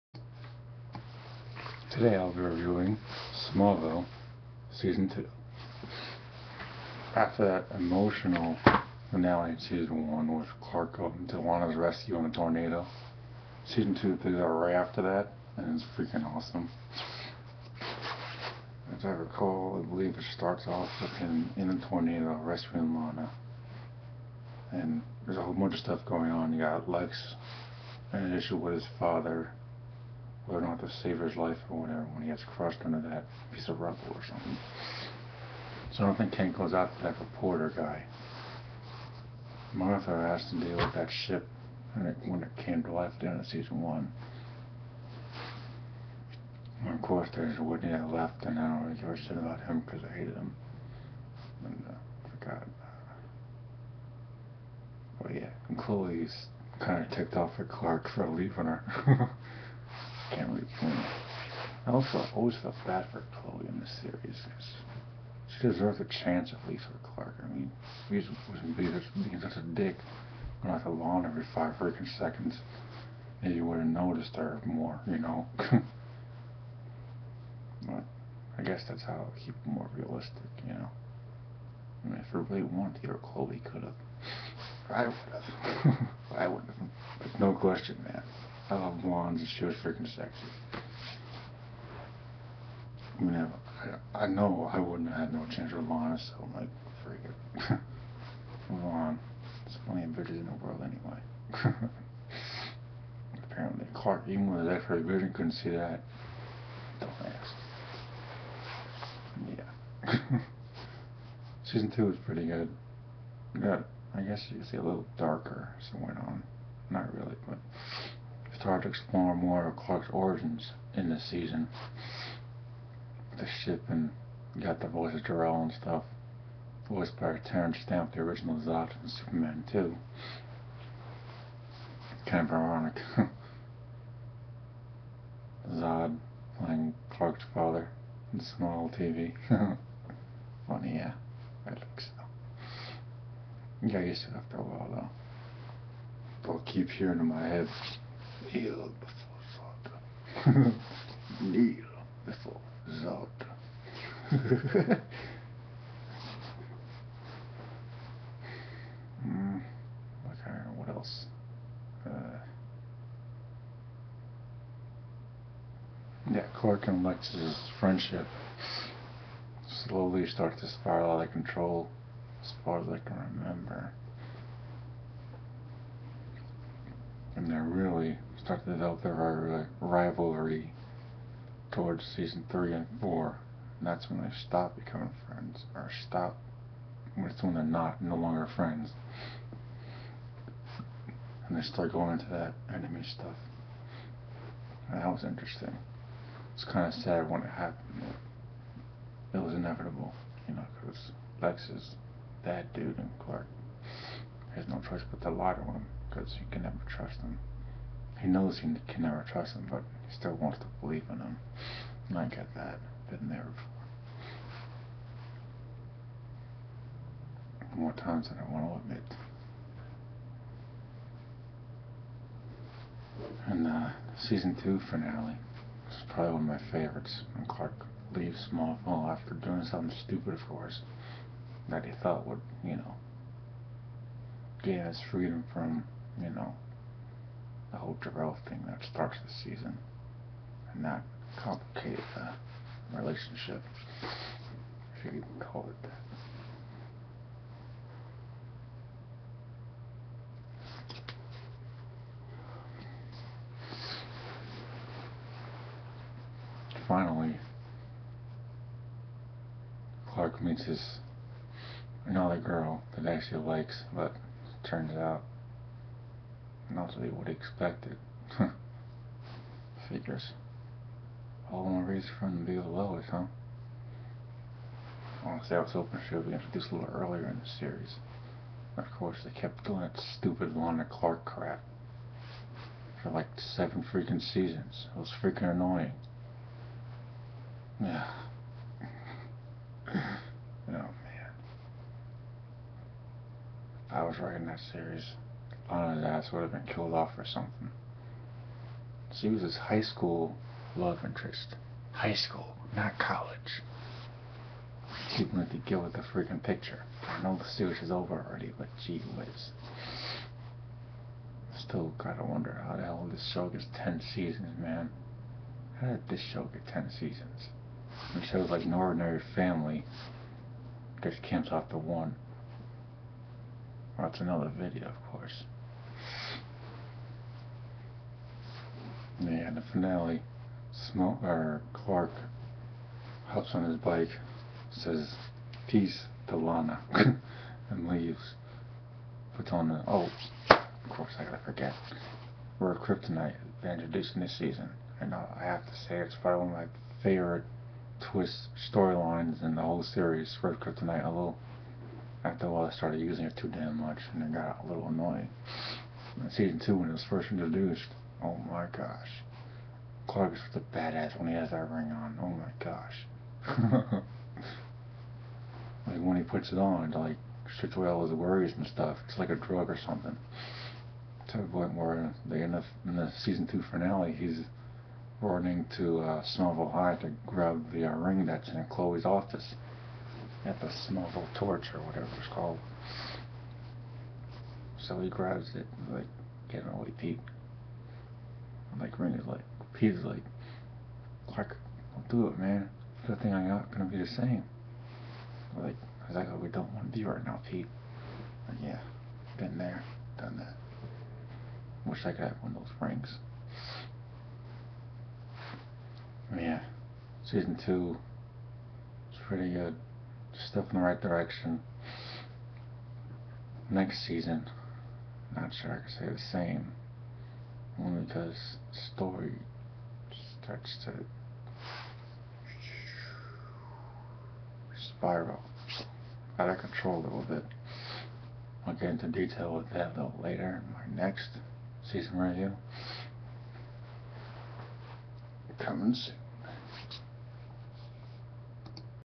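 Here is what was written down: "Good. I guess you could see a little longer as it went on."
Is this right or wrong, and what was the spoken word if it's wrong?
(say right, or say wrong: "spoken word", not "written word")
wrong: "darker", not "longer".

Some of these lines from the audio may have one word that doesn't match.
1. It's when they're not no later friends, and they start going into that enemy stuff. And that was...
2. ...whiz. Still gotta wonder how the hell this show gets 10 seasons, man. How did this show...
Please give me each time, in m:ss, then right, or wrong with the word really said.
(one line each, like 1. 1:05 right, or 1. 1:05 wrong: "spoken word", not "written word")
1. 3:07 wrong: "longer", not "later"
2. 5:09 right.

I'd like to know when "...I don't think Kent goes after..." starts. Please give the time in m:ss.
0:36.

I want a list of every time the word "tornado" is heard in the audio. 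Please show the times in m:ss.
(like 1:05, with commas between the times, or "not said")
0:12, 0:21.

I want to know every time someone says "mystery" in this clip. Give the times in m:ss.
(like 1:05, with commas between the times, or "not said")
not said.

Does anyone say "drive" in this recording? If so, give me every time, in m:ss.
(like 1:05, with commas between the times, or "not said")
not said.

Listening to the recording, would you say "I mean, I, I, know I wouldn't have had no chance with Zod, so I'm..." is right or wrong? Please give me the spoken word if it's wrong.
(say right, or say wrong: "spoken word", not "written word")
wrong: "Lana", not "Zod".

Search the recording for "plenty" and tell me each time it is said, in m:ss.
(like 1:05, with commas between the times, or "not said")
1:39.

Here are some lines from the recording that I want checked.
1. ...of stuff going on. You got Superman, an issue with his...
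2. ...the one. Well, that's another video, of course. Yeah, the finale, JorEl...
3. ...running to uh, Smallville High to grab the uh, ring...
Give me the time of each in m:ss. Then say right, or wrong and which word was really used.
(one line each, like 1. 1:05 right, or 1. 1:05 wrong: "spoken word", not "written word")
1. 0:25 wrong: "Lex", not "Superman"
2. 5:21 wrong: "Smoke", not "JorEl"
3. 6:15 right.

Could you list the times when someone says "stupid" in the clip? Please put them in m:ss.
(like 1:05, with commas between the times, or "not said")
3:50, 4:40.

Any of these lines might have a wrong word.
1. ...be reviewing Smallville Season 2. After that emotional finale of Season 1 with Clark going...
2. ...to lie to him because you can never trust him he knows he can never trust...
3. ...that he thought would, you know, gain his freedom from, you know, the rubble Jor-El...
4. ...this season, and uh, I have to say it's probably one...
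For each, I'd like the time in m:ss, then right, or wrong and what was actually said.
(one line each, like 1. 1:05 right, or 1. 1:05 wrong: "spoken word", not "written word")
1. 0:02 right
2. 3:25 right
3. 3:51 wrong: "whole", not "rubble"
4. 5:43 right.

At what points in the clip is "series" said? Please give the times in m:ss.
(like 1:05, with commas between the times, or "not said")
1:04, 4:37, 4:54, 5:07, 5:49.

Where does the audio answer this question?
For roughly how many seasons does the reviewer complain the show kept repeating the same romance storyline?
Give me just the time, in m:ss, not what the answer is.
4:43.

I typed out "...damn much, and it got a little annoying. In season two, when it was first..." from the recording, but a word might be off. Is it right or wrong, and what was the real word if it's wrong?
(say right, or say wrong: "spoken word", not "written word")
right.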